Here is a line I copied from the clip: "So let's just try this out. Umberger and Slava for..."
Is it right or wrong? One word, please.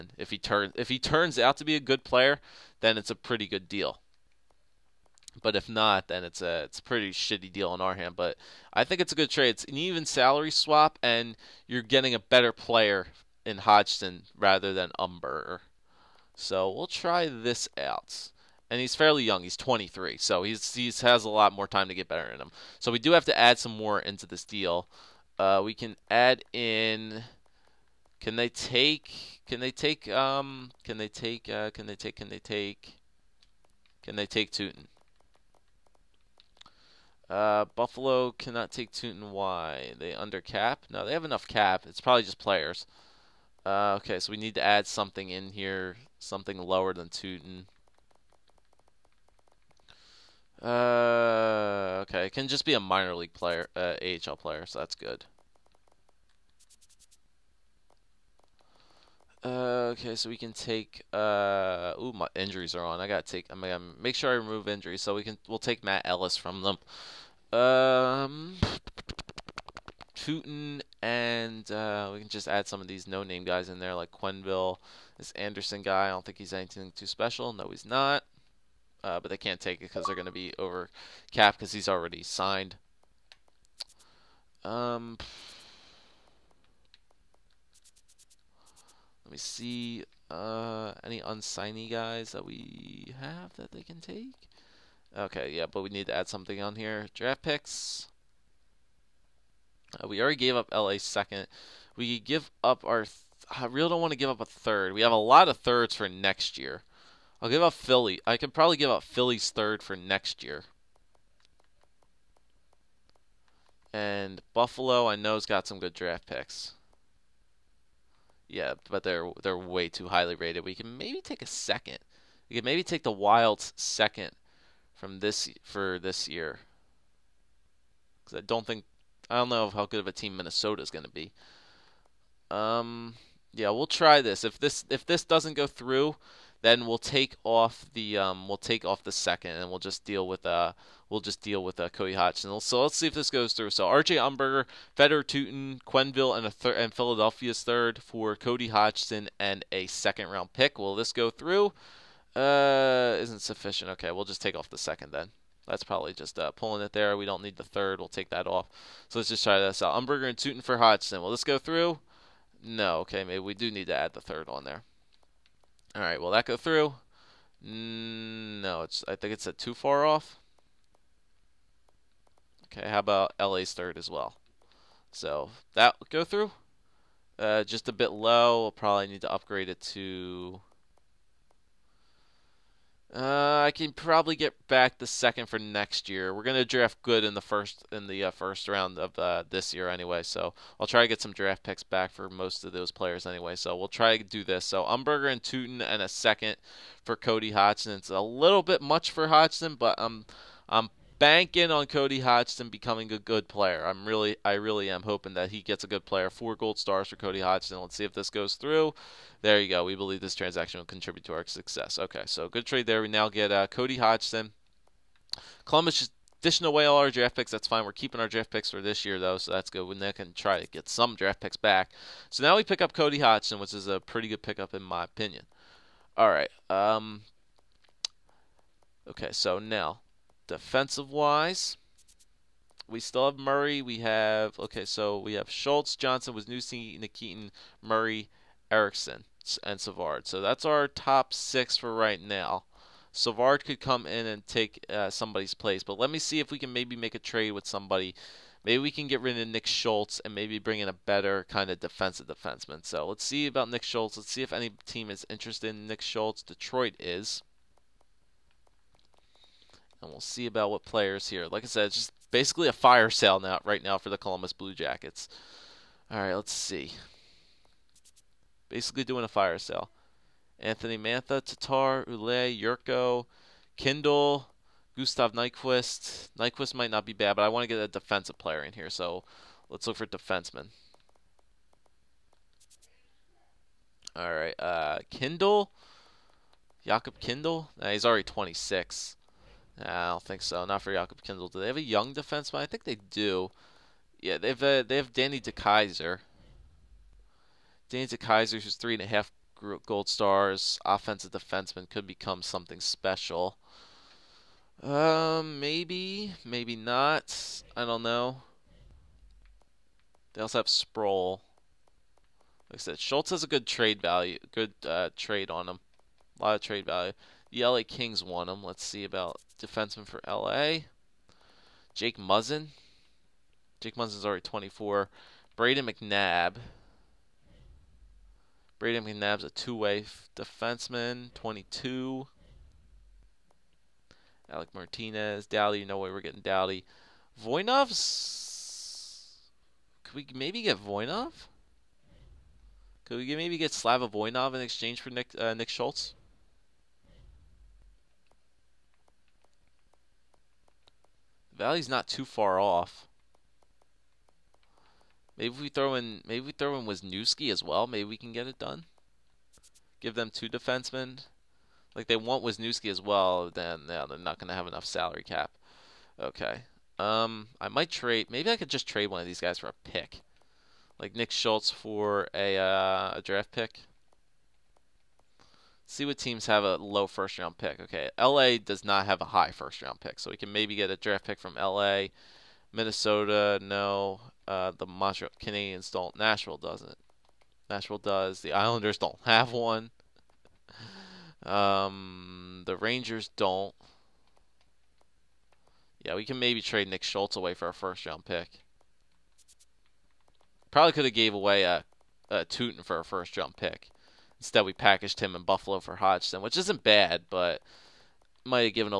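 wrong.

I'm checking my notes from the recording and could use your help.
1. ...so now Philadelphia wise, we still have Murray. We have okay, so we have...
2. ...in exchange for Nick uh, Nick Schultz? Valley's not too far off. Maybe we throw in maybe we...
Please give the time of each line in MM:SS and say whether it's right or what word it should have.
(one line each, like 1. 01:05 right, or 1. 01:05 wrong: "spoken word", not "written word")
1. 03:49 wrong: "Defensive", not "Philadelphia"
2. 05:44 right.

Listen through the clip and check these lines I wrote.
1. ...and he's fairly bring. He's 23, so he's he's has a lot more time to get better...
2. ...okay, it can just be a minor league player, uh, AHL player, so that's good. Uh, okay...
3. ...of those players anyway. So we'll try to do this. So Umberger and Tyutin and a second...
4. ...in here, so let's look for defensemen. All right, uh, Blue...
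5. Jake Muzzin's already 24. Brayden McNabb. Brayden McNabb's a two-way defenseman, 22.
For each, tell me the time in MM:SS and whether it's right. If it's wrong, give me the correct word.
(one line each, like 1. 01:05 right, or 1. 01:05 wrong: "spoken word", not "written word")
1. 00:18 wrong: "young", not "bring"
2. 00:52 right
3. 03:12 right
4. 04:38 wrong: "Kindl", not "Blue"
5. 05:23 right.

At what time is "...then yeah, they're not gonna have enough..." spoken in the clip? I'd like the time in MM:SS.
06:03.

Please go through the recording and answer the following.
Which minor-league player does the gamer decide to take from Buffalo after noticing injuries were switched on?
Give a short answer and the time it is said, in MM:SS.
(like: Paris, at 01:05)
Matt Ellis, at 01:05.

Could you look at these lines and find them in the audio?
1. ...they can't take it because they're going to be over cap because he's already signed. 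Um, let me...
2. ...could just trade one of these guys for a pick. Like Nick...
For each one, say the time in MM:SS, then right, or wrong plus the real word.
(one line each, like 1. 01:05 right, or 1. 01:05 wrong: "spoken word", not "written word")
1. 01:19 right
2. 06:08 right.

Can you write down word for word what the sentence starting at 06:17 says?
Okay, LA does not have a high first round pick, so we can maybe get a draft pick from LA.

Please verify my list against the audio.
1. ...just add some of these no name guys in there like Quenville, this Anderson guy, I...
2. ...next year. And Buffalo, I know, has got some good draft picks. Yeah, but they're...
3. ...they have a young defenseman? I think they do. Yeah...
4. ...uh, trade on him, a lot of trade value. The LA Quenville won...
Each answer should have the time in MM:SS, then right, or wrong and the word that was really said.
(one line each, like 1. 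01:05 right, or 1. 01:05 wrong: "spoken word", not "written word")
1. 01:12 right
2. 01:49 right
3. 04:51 right
4. 05:14 wrong: "Kings", not "Quenville".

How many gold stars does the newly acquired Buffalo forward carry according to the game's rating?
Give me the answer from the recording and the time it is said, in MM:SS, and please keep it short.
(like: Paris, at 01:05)
4, at 03:26.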